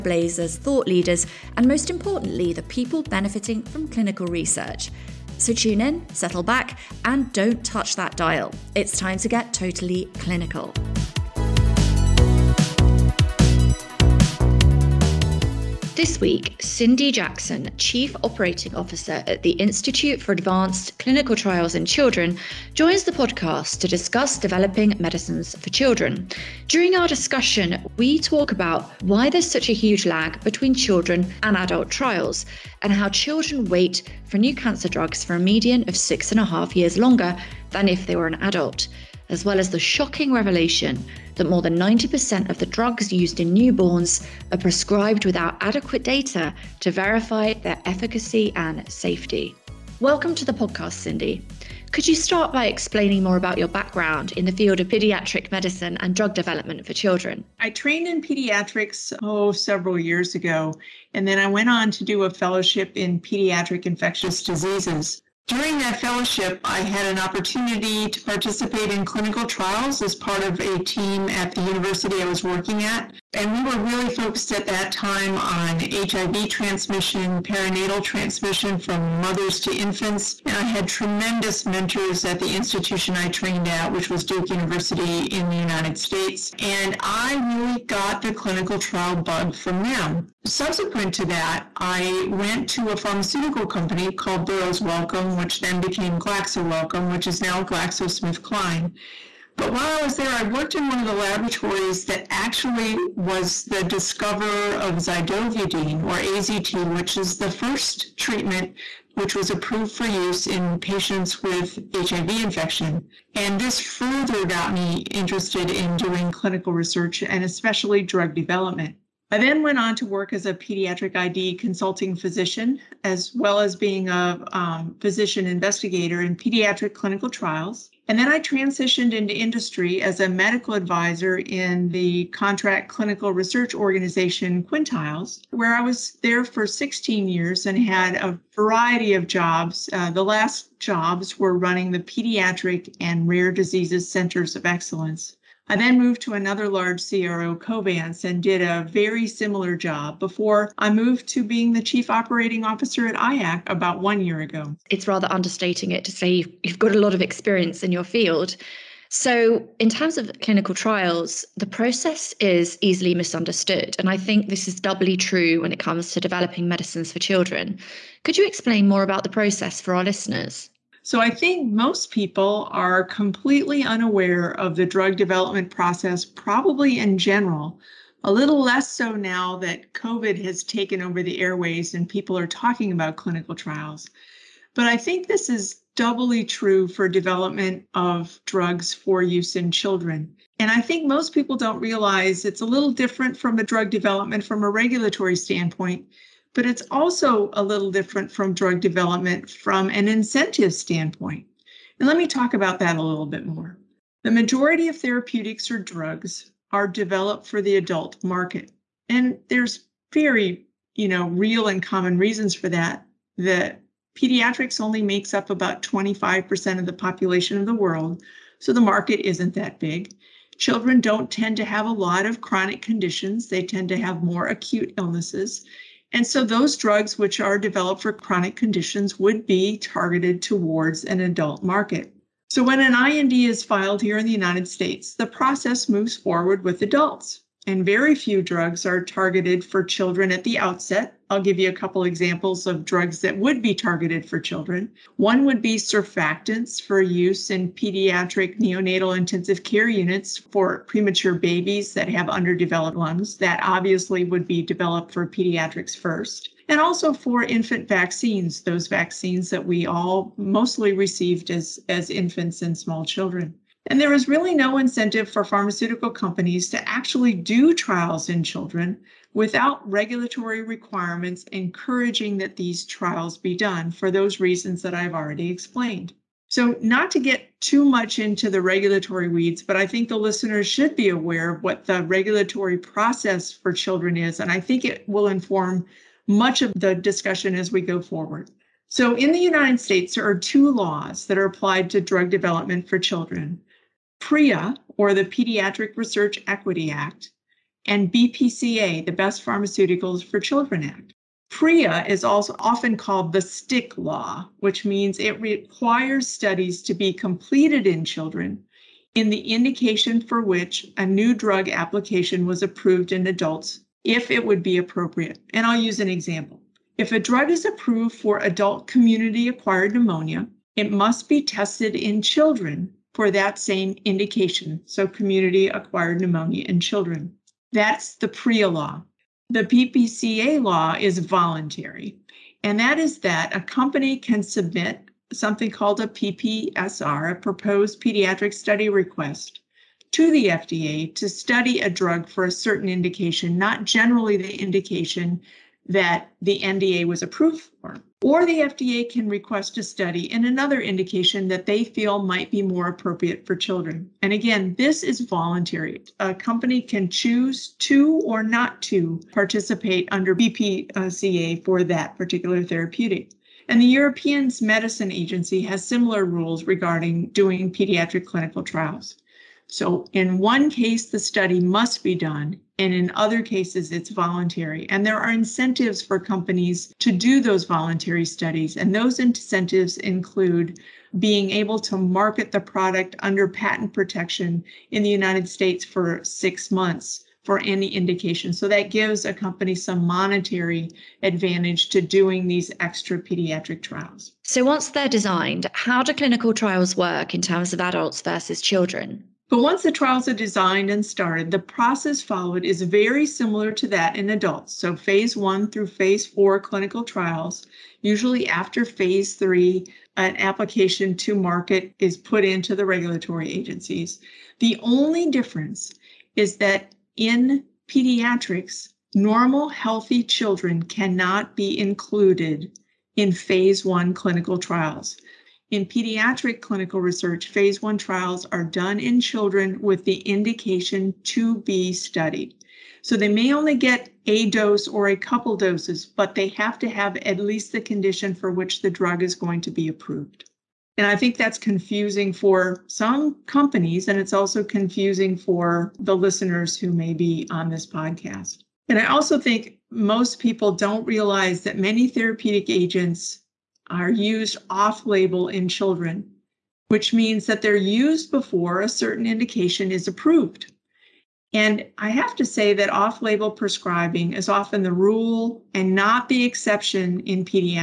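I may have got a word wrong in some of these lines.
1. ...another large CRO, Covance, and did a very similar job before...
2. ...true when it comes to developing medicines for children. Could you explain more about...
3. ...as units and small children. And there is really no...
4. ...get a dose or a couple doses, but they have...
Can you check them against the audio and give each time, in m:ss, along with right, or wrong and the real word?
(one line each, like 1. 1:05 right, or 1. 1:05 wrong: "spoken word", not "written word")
1. 2:26 right
2. 2:45 right
3. 4:21 wrong: "infants", not "units"
4. 7:13 right.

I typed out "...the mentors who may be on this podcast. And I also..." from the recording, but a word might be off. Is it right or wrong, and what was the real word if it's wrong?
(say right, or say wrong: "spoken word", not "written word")
wrong: "listeners", not "mentors".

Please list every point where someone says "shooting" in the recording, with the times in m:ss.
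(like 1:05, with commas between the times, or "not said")
not said.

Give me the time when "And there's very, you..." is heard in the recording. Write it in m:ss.
3:29.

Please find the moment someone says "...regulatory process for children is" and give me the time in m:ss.
4:42.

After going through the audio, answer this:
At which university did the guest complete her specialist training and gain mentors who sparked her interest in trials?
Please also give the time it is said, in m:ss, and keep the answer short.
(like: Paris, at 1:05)
Duke University, at 1:24.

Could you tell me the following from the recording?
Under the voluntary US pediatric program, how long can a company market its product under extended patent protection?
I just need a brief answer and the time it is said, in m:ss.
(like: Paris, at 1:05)
6 months, at 6:26.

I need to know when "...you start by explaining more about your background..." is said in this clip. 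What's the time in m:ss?
0:52.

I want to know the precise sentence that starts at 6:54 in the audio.
The only difference is that in pediatrics, normal healthy children cannot be included in phase one clinical trials.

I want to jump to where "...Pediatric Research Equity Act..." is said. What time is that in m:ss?
4:55.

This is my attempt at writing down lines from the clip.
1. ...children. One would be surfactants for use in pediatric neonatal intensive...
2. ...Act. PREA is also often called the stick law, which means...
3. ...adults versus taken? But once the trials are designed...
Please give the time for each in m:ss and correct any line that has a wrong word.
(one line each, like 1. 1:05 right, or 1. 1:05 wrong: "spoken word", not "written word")
1. 4:04 right
2. 5:00 right
3. 6:37 wrong: "children", not "taken".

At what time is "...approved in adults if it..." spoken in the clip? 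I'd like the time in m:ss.
5:12.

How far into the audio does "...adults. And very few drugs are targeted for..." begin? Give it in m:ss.
3:56.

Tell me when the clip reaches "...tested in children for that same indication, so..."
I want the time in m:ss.
5:21.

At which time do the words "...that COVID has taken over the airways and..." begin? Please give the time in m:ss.
2:59.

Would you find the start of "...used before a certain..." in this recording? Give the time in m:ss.
7:37.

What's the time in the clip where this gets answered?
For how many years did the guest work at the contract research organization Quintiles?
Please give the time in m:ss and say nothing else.
2:16.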